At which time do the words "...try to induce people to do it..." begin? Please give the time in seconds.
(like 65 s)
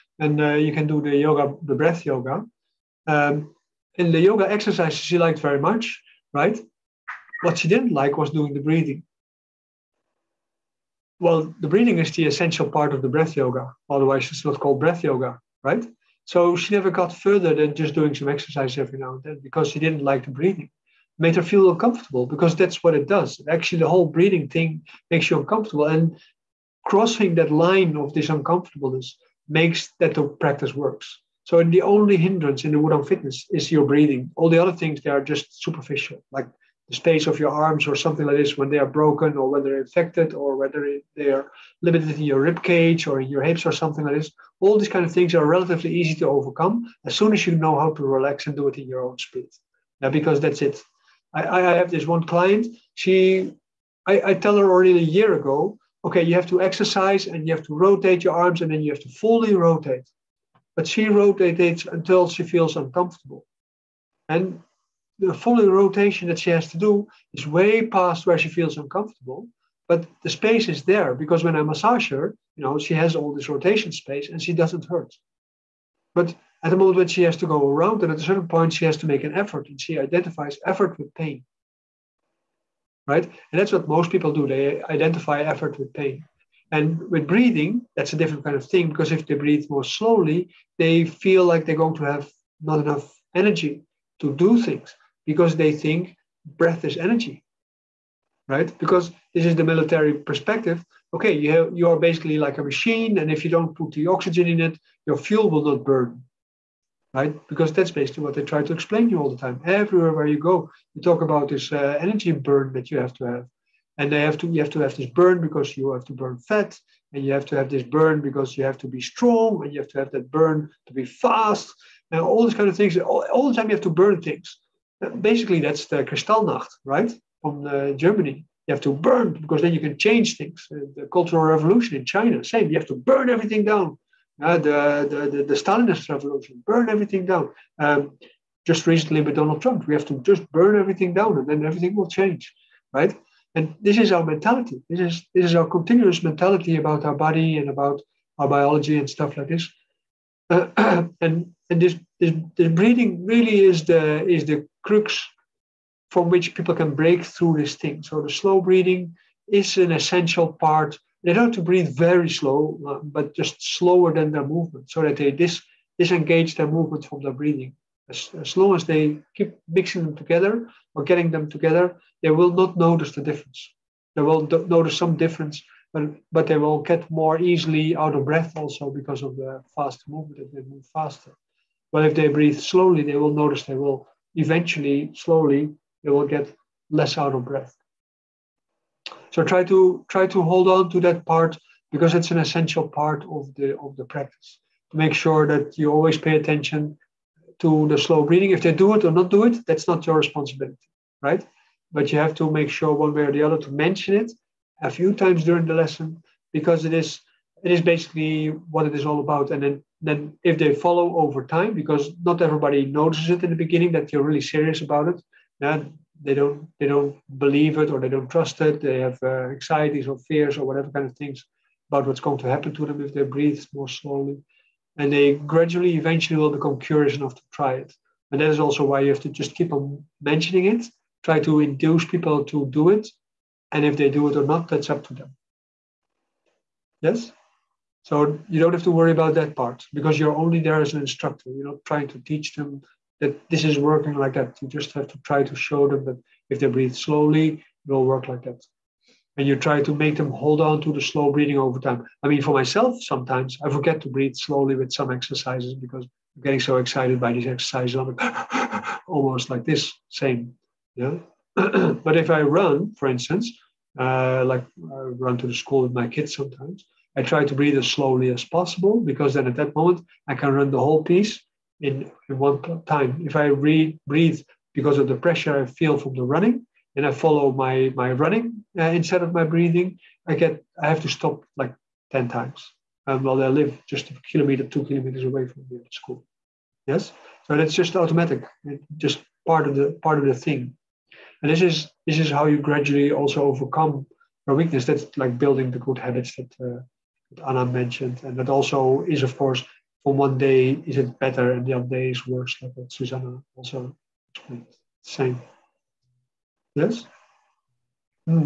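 231 s.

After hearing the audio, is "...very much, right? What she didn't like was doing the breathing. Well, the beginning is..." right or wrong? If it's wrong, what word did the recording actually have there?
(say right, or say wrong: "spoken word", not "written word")
wrong: "breathing", not "beginning".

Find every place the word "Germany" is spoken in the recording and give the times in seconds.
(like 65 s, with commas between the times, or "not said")
127 s.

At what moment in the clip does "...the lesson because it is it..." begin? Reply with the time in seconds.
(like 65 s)
205 s.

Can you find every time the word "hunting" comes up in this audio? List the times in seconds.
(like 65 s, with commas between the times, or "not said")
not said.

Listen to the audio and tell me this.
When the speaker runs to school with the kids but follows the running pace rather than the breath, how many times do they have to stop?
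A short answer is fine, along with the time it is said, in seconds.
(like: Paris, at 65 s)
10, at 282 s.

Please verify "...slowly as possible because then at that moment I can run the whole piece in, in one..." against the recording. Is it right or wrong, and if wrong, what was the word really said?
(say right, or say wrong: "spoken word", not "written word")
right.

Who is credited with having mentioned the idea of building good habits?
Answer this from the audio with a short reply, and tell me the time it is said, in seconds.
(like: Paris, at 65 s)
Anna, at 297 s.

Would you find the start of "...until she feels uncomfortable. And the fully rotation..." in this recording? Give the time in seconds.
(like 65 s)
61 s.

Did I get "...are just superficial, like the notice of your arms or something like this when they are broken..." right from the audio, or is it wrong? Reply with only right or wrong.
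wrong.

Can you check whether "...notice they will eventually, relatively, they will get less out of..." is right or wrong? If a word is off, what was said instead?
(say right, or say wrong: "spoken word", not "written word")
wrong: "slowly", not "relatively".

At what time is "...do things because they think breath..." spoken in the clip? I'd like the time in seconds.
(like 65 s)
94 s.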